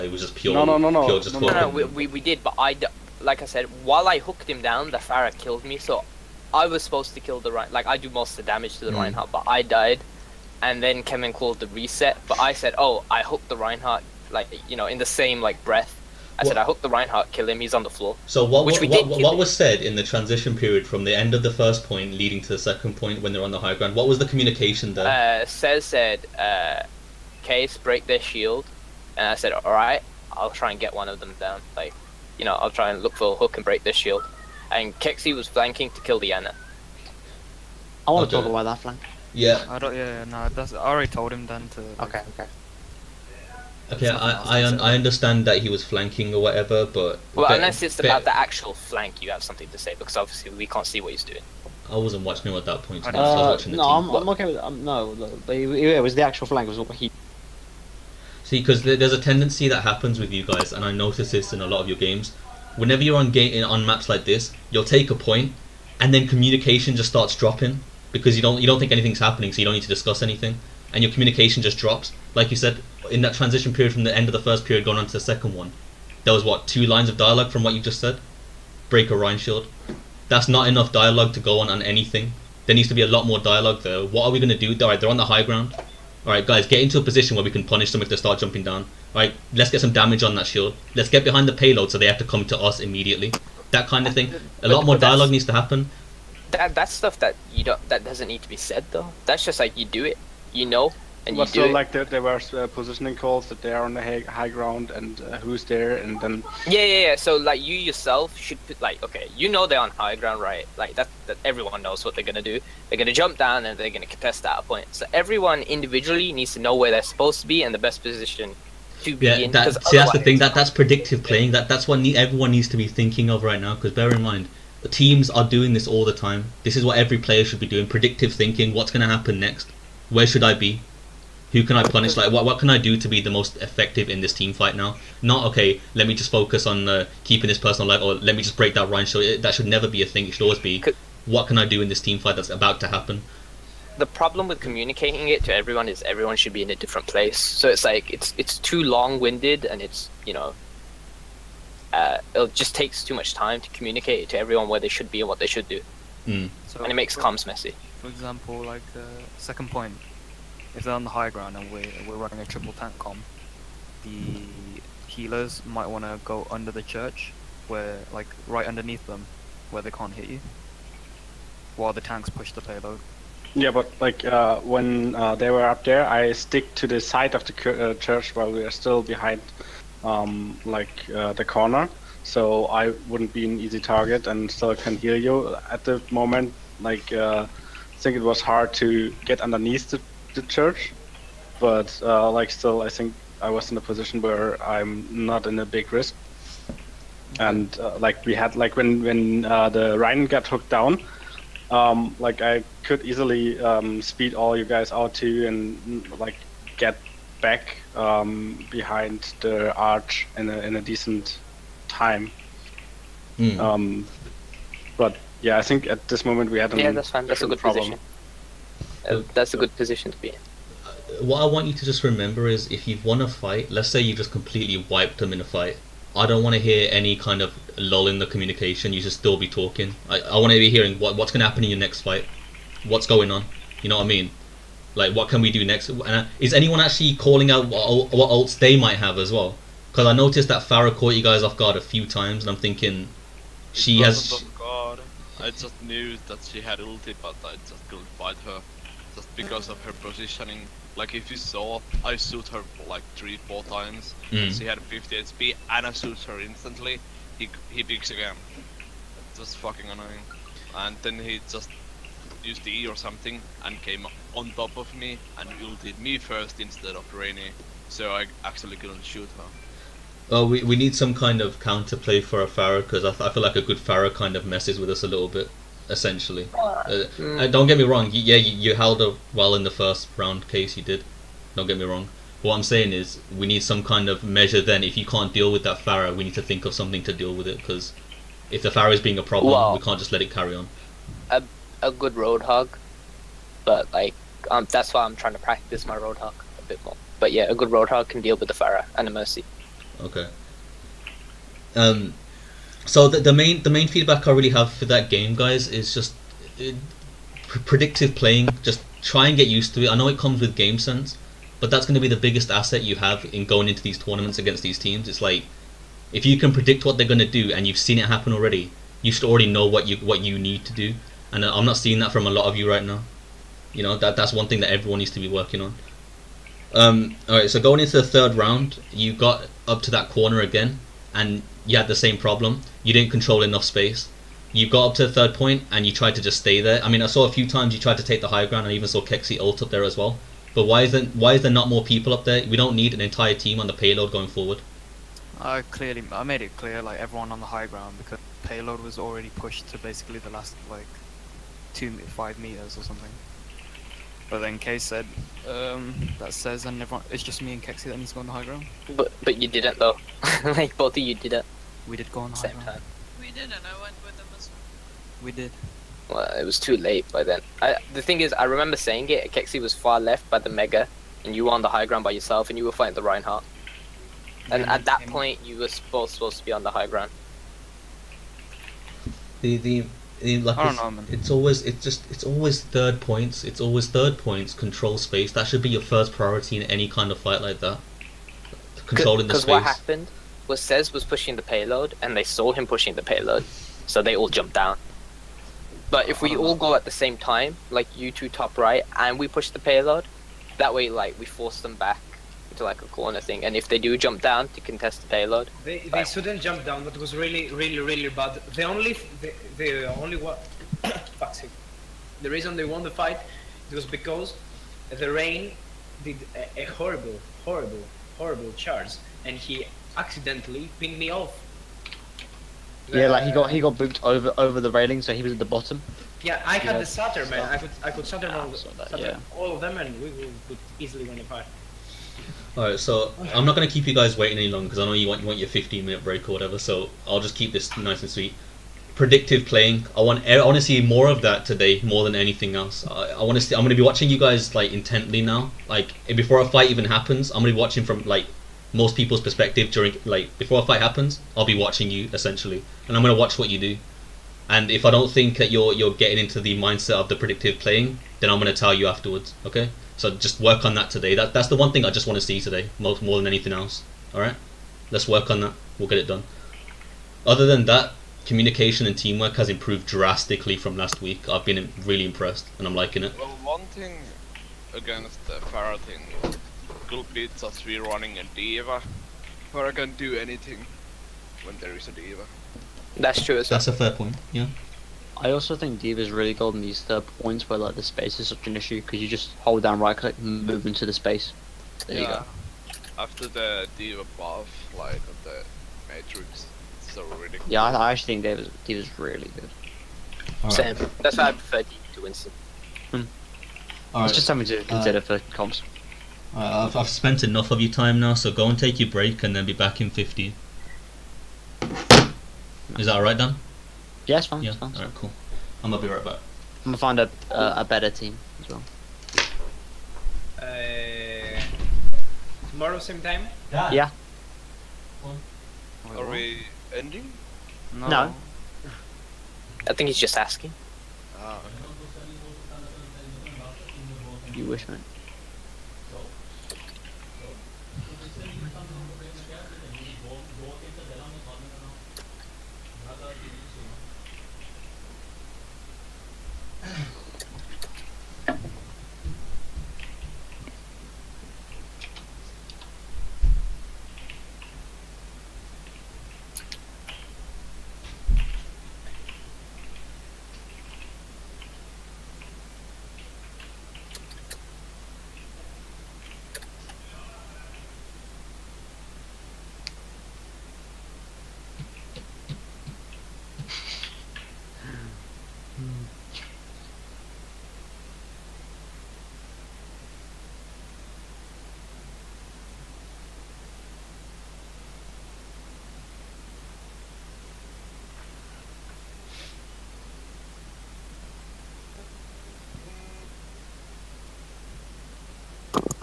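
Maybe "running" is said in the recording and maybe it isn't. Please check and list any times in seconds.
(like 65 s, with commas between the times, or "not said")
162 s, 477 s.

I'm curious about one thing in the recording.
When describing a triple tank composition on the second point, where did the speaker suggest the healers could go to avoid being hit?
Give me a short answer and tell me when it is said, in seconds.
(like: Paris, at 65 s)
Under the church, at 166 s.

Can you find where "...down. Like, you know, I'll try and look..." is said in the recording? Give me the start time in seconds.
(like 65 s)
31 s.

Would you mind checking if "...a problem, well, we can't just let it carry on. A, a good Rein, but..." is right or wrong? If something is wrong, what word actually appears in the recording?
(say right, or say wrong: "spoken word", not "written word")
wrong: "Roadhog", not "Rein".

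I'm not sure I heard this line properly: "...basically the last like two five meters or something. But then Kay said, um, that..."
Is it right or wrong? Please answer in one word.
right.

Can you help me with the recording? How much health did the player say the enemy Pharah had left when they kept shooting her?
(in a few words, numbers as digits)
50 HP.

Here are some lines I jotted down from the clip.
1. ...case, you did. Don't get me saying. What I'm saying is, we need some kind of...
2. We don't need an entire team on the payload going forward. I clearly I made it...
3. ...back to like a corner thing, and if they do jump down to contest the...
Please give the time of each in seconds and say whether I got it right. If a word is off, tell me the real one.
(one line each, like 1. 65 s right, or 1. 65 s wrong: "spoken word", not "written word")
1. 280 s wrong: "wrong", not "saying"
2. 342 s right
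3. 401 s right.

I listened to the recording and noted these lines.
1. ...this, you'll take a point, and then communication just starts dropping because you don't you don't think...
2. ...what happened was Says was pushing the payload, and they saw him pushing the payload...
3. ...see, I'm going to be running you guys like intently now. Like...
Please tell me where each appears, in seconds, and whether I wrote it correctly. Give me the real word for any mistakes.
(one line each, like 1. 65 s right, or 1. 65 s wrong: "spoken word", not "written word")
1. 64 s right
2. 389 s right
3. 443 s wrong: "watching", not "running".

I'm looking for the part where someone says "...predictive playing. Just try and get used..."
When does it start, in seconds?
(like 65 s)
307 s.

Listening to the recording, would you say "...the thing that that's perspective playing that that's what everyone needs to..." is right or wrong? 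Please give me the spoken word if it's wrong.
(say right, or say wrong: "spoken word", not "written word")
wrong: "predictive", not "perspective".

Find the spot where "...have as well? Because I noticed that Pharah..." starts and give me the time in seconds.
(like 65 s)
238 s.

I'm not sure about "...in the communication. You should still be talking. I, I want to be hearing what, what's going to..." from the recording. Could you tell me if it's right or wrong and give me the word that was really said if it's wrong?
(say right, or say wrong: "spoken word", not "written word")
right.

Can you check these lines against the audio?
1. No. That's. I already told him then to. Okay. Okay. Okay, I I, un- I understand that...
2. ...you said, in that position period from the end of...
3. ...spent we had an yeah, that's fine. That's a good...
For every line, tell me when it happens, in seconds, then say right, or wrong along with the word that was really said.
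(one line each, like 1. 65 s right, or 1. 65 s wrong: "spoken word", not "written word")
1. 40 s right
2. 72 s wrong: "transition", not "position"
3. 216 s wrong: "moment", not "spent".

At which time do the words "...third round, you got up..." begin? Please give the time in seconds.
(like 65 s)
328 s.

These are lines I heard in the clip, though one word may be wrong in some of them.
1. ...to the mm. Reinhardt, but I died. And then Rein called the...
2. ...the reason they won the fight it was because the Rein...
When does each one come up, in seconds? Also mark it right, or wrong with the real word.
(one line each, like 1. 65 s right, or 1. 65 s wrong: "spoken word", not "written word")
1. 8 s wrong: "Kevin", not "Rein"
2. 412 s right.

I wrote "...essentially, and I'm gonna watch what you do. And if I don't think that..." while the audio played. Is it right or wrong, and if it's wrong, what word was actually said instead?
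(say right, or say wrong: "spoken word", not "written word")
right.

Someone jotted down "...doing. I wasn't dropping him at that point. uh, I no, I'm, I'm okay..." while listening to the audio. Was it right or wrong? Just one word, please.
wrong.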